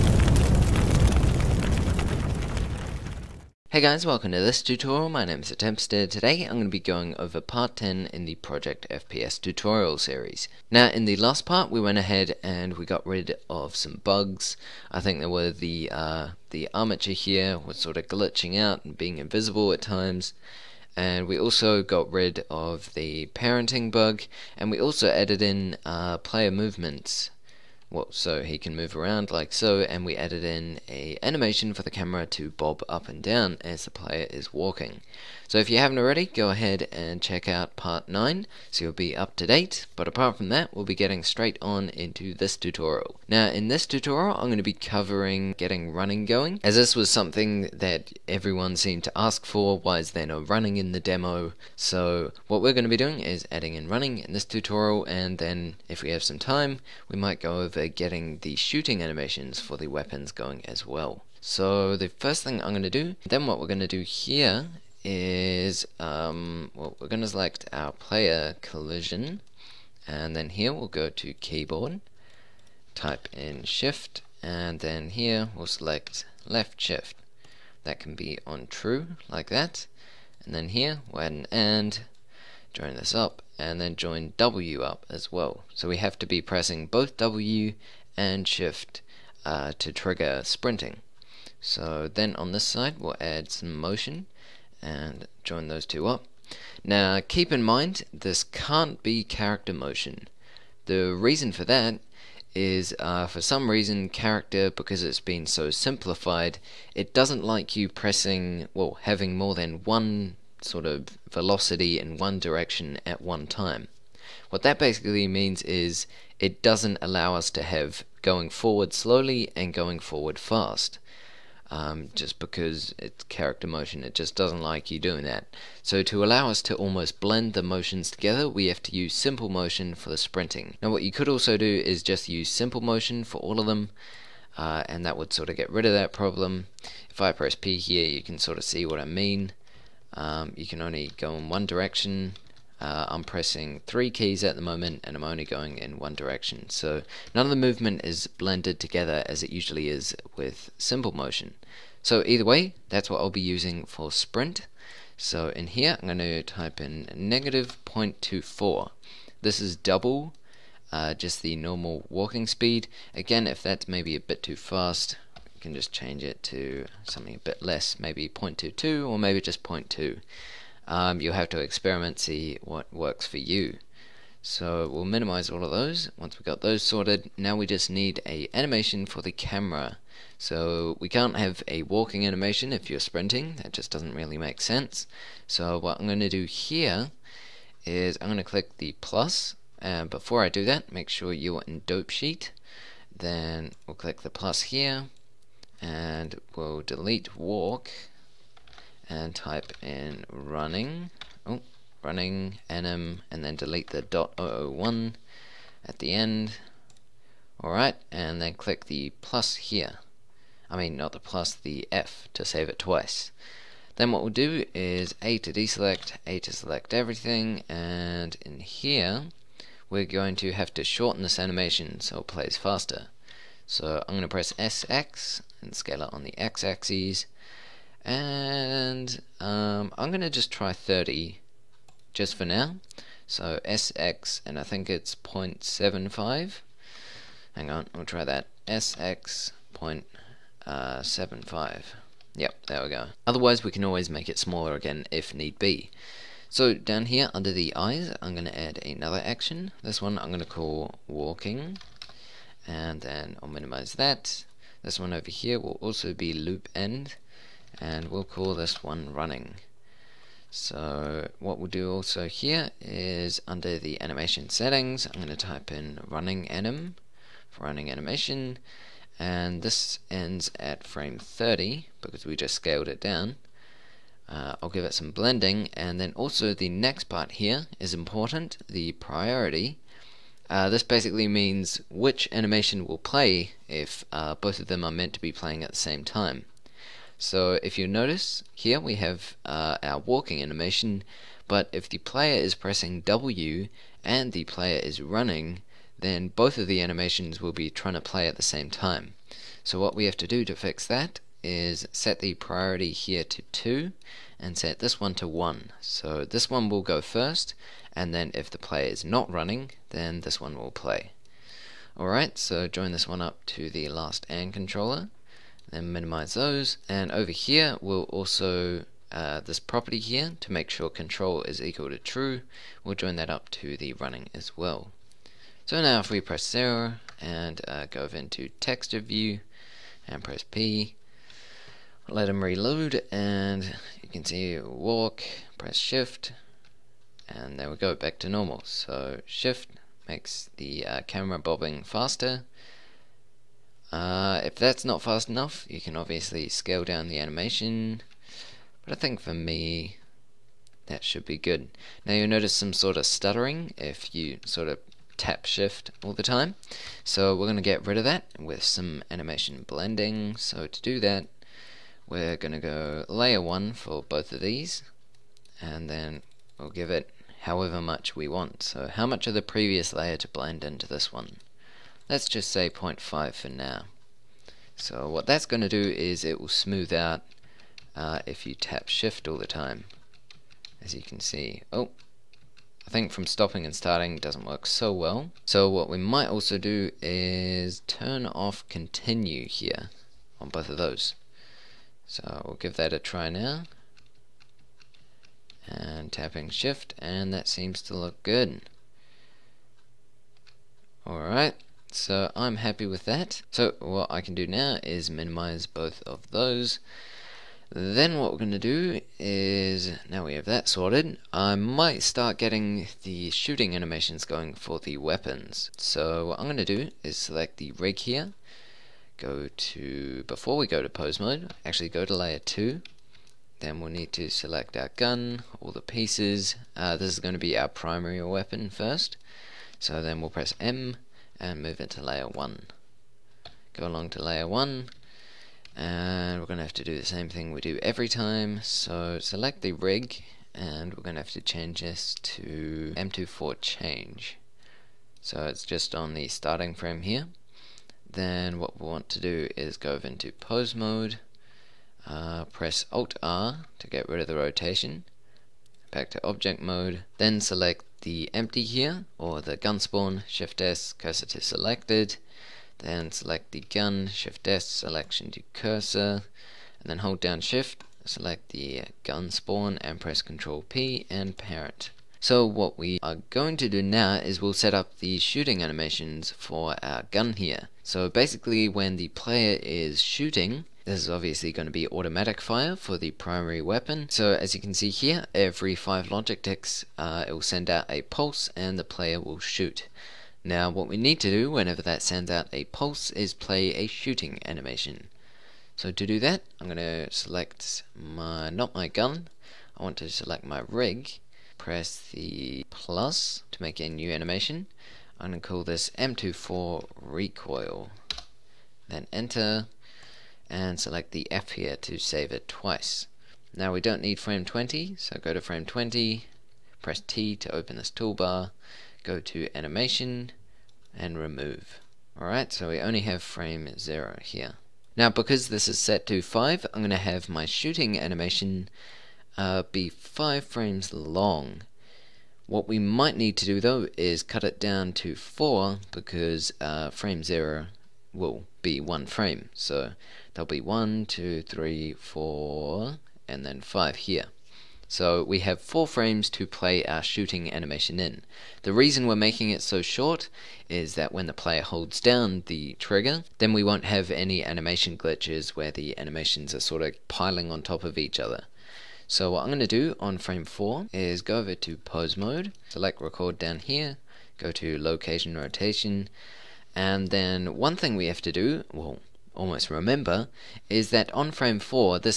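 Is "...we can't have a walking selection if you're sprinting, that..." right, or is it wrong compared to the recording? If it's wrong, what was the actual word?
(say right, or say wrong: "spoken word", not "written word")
wrong: "animation", not "selection".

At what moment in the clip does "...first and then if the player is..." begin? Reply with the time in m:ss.
5:07.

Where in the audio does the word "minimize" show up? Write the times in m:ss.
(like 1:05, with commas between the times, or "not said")
2:55, 4:13, 5:15, 6:45.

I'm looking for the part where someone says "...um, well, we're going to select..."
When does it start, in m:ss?
1:05.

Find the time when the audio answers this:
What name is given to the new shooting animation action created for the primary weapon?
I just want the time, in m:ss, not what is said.
8:25.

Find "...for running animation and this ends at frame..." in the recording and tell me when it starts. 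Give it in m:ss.
4:27.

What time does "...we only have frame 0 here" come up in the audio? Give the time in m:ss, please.
8:42.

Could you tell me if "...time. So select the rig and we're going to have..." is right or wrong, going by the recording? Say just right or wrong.
right.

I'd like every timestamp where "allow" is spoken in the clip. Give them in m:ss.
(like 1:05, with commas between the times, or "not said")
1:57, 2:06.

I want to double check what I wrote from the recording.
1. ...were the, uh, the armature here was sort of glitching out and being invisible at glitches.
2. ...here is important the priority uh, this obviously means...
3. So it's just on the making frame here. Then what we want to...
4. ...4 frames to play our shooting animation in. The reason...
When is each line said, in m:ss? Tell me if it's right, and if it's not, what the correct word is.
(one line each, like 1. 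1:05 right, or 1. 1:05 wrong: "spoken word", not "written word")
1. 0:15 wrong: "times", not "glitches"
2. 4:37 wrong: "basically", not "obviously"
3. 7:25 wrong: "starting", not "making"
4. 9:05 right.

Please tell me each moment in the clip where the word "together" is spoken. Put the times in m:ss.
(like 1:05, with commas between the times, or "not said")
2:08, 2:28.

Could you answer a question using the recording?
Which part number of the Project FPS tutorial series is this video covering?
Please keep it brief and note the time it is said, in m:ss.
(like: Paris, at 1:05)
10, at 0:07.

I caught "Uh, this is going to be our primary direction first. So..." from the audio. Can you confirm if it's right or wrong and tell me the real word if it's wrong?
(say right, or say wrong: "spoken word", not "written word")
wrong: "weapon", not "direction".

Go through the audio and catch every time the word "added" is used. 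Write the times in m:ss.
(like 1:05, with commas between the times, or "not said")
0:25, 0:30.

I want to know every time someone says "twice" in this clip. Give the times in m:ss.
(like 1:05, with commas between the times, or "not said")
3:32, 8:32.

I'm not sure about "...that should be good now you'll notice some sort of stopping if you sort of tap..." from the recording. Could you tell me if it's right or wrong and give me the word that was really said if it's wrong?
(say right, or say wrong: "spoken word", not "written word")
wrong: "stuttering", not "stopping".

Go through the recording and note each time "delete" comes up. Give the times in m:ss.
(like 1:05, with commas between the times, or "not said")
3:16, 3:23.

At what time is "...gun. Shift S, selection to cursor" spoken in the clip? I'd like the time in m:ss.
7:43.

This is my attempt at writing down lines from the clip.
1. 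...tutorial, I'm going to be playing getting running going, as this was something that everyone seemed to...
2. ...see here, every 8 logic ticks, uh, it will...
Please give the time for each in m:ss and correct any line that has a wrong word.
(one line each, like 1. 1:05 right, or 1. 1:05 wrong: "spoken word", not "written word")
1. 0:43 wrong: "covering", not "playing"
2. 8:04 wrong: "5", not "8".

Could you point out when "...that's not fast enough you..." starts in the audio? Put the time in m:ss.
5:44.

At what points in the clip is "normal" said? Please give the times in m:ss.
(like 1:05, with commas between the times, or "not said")
2:41, 5:38.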